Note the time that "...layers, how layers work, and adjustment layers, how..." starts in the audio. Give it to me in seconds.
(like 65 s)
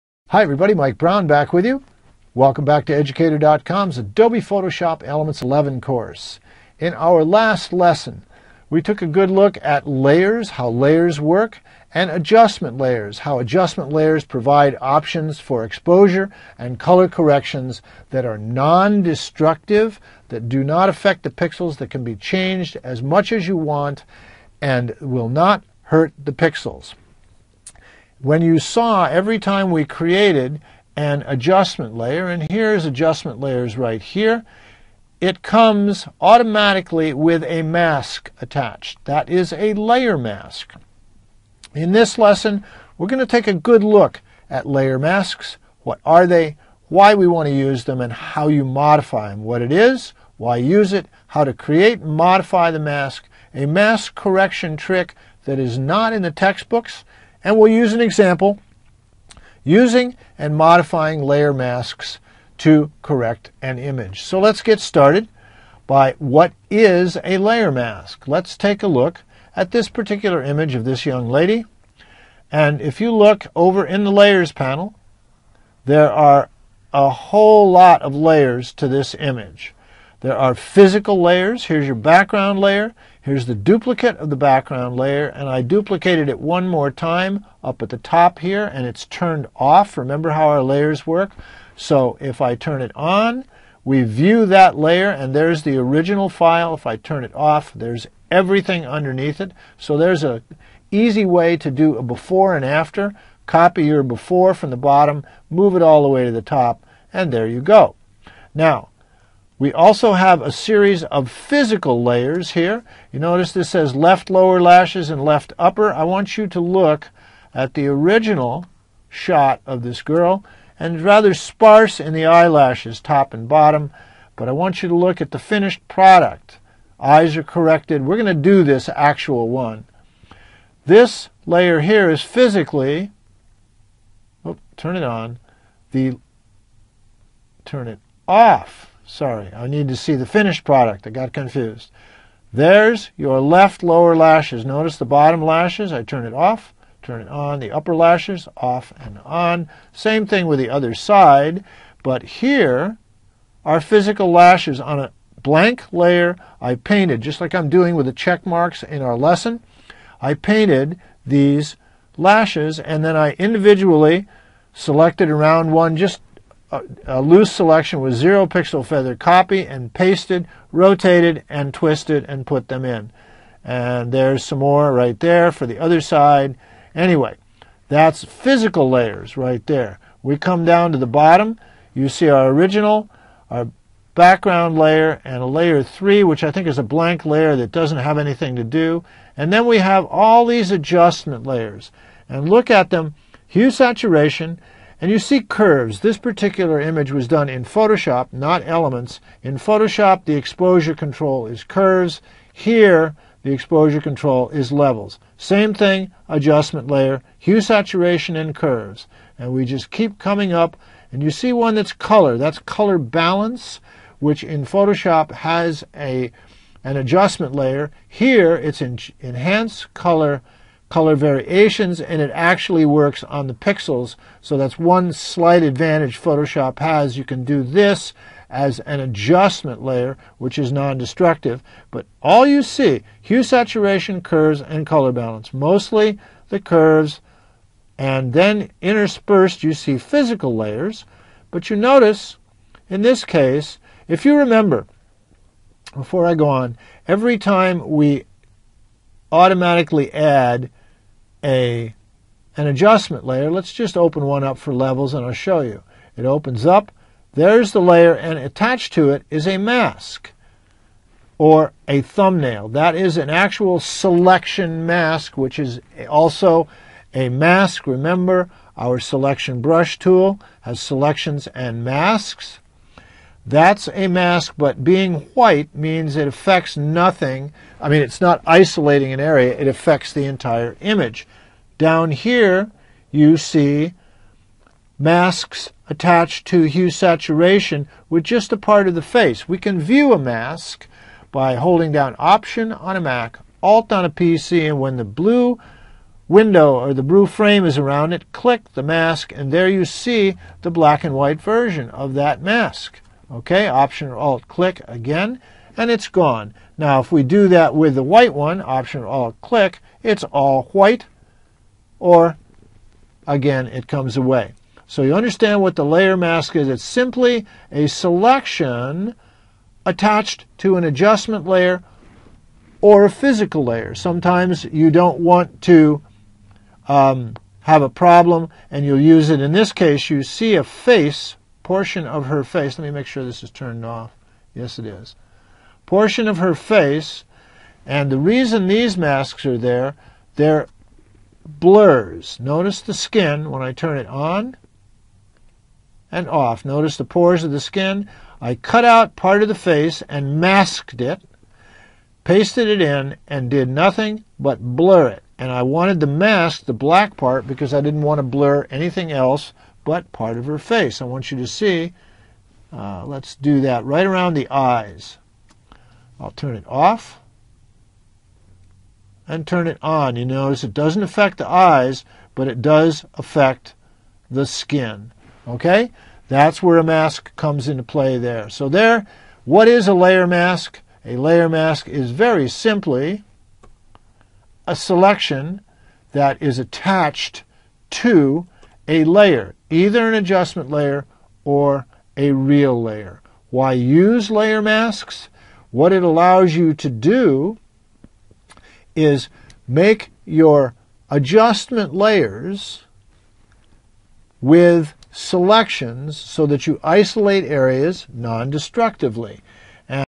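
9 s.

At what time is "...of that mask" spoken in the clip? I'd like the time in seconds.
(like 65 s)
301 s.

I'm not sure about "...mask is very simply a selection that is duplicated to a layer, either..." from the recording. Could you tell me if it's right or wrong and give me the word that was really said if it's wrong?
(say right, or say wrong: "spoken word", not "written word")
wrong: "attached", not "duplicated".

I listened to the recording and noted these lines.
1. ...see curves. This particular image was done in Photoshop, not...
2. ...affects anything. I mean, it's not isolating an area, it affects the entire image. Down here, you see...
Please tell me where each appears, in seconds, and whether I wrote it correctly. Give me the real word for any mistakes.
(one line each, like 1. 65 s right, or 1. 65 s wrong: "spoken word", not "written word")
1. 195 s right
2. 276 s wrong: "nothing", not "anything".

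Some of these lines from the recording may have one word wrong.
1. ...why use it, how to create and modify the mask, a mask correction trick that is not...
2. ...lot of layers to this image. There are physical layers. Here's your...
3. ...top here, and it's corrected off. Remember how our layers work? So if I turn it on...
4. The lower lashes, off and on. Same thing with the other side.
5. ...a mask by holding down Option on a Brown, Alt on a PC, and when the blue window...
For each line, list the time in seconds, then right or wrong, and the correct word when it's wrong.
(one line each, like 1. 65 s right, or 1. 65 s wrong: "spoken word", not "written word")
1. 50 s right
2. 77 s right
3. 87 s wrong: "turned", not "corrected"
4. 147 s wrong: "upper", not "lower"
5. 290 s wrong: "Mac", not "Brown".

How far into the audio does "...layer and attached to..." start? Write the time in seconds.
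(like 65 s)
257 s.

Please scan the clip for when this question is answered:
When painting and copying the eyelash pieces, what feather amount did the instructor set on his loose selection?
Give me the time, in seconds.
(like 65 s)
168 s.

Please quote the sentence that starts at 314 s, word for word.
So you understand what the layer mask is.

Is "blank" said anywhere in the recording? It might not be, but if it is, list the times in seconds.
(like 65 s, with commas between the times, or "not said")
155 s, 186 s.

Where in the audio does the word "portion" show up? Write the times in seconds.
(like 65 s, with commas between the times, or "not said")
331 s, 335 s.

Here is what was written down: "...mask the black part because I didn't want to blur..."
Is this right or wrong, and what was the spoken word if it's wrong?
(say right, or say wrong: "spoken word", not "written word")
right.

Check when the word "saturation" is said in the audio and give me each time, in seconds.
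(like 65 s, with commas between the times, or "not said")
193 s, 207 s, 233 s, 286 s.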